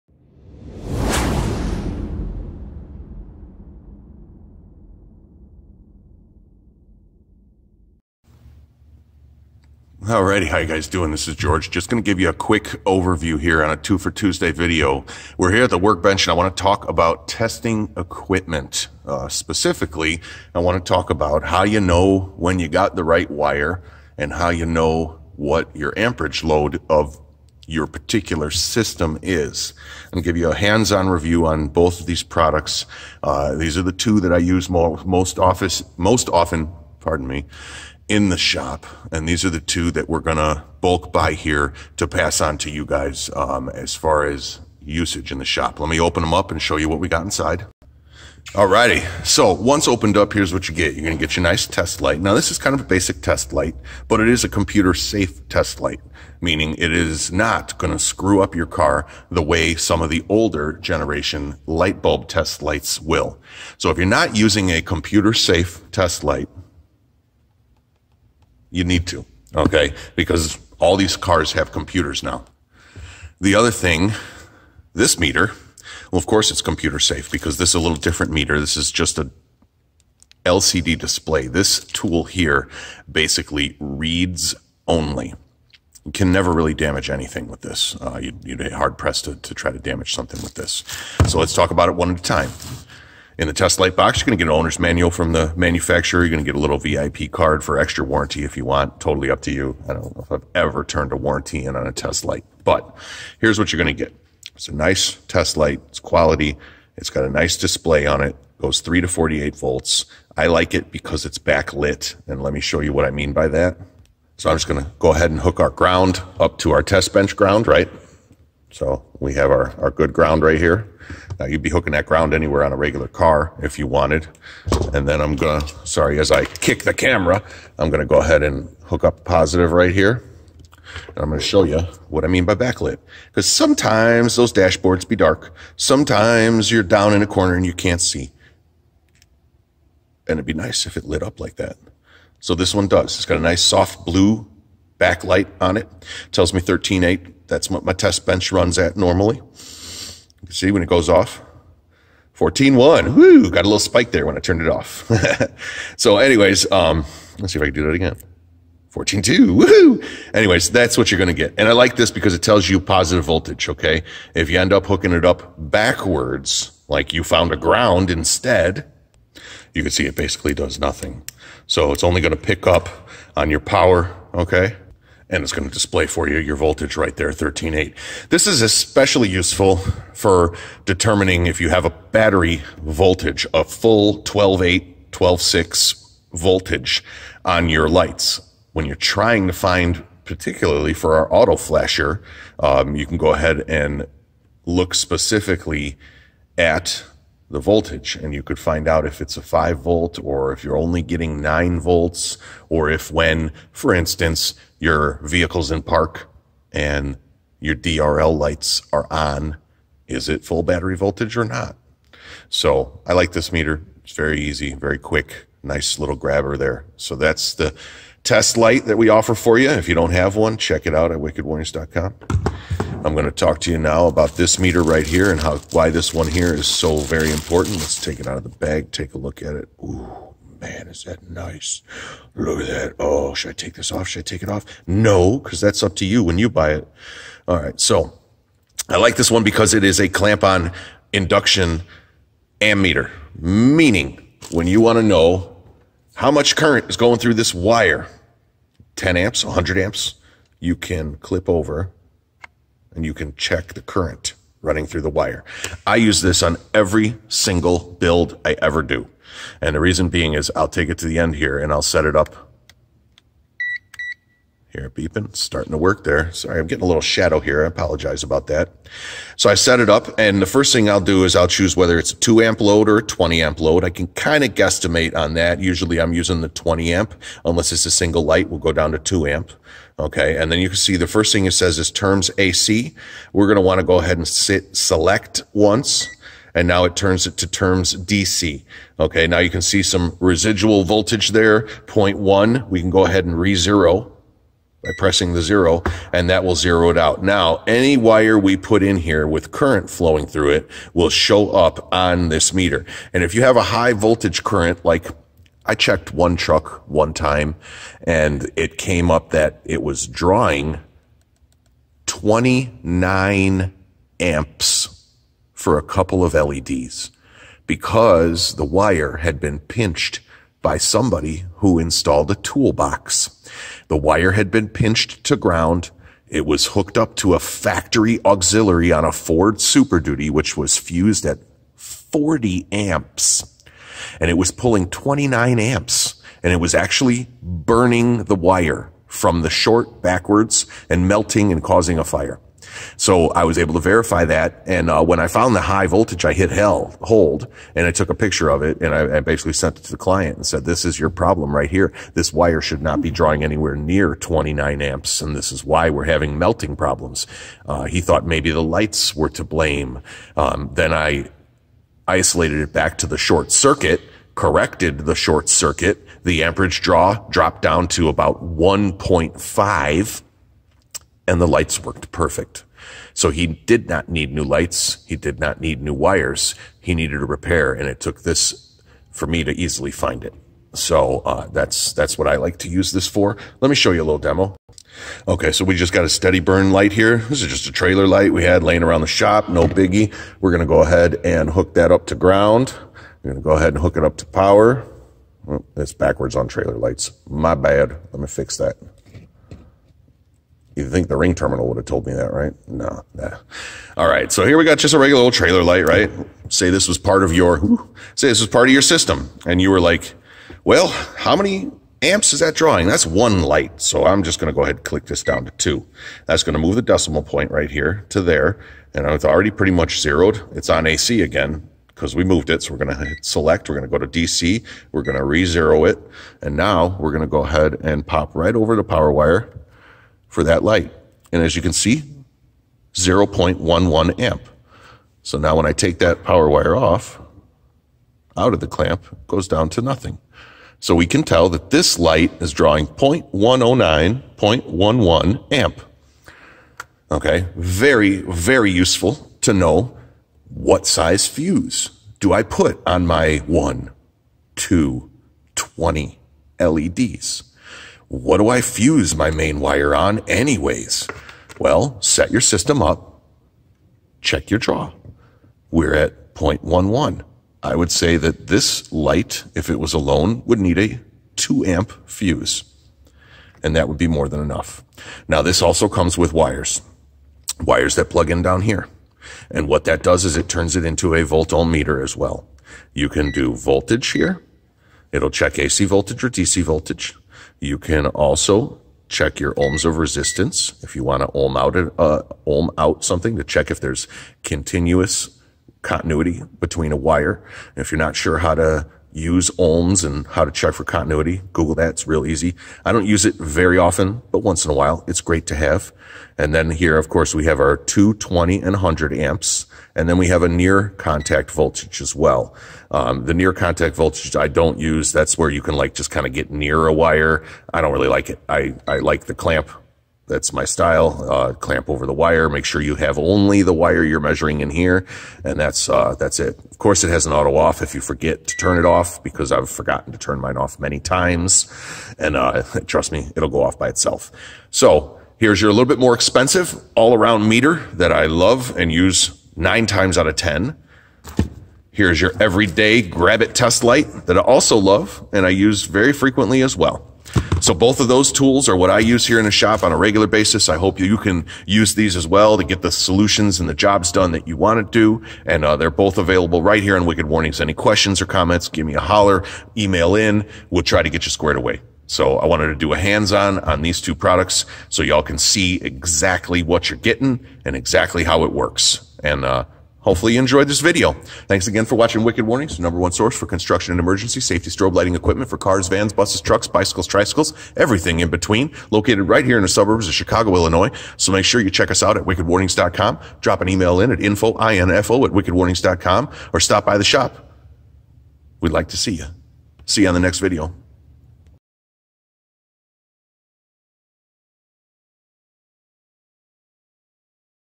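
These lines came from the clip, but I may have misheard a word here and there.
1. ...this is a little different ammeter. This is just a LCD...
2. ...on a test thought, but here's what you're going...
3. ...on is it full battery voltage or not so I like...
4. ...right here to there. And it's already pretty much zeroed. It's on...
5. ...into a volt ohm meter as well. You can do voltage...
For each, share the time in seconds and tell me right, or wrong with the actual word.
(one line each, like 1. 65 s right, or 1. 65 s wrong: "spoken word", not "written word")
1. 77 s wrong: "meter", not "ammeter"
2. 101 s wrong: "light", not "thought"
3. 209 s right
4. 417 s right
5. 480 s right.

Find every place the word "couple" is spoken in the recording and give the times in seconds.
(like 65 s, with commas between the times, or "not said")
315 s.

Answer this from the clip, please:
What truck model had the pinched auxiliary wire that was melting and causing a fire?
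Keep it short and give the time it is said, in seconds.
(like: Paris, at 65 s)
Ford Super Duty, at 329 s.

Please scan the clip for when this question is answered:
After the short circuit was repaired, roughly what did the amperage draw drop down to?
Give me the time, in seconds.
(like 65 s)
368 s.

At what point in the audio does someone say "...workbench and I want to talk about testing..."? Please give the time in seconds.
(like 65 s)
15 s.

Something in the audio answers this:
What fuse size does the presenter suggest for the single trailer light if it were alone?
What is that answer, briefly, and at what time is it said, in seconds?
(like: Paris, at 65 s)
2 amp, at 471 s.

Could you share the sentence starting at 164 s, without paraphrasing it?
If you end up hooking it up backwards, like you found a ground instead, you can see it basically does nothing.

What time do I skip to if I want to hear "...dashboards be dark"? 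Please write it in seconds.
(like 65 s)
134 s.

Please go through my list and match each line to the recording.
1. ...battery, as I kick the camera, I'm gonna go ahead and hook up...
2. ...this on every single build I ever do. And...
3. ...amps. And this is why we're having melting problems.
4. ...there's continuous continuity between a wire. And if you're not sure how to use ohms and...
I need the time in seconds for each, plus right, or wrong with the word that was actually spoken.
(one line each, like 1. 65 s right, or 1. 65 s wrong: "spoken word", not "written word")
1. 125 s wrong: "sorry", not "battery"
2. 256 s right
3. 354 s right
4. 493 s right.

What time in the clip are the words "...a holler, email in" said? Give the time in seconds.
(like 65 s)
558 s.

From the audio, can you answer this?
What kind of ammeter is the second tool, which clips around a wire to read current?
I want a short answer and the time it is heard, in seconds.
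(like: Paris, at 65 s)
Clamp-on induction ammeter, at 240 s.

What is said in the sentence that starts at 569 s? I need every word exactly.
And, uh, Hopefully you enjoyed this video.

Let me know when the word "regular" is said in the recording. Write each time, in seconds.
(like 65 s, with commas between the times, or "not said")
122 s, 404 s, 549 s.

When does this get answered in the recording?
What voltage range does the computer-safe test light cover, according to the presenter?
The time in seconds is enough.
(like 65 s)
108 s.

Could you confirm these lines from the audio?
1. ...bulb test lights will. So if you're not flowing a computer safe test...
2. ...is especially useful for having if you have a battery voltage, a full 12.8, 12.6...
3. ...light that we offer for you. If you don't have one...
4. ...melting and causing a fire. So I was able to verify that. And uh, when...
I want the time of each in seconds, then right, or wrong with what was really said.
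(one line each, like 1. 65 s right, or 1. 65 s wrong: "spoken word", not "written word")
1. 62 s wrong: "using", not "flowing"
2. 178 s wrong: "determining", not "having"
3. 218 s right
4. 341 s right.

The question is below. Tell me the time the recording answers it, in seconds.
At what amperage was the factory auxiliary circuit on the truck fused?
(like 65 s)
331 s.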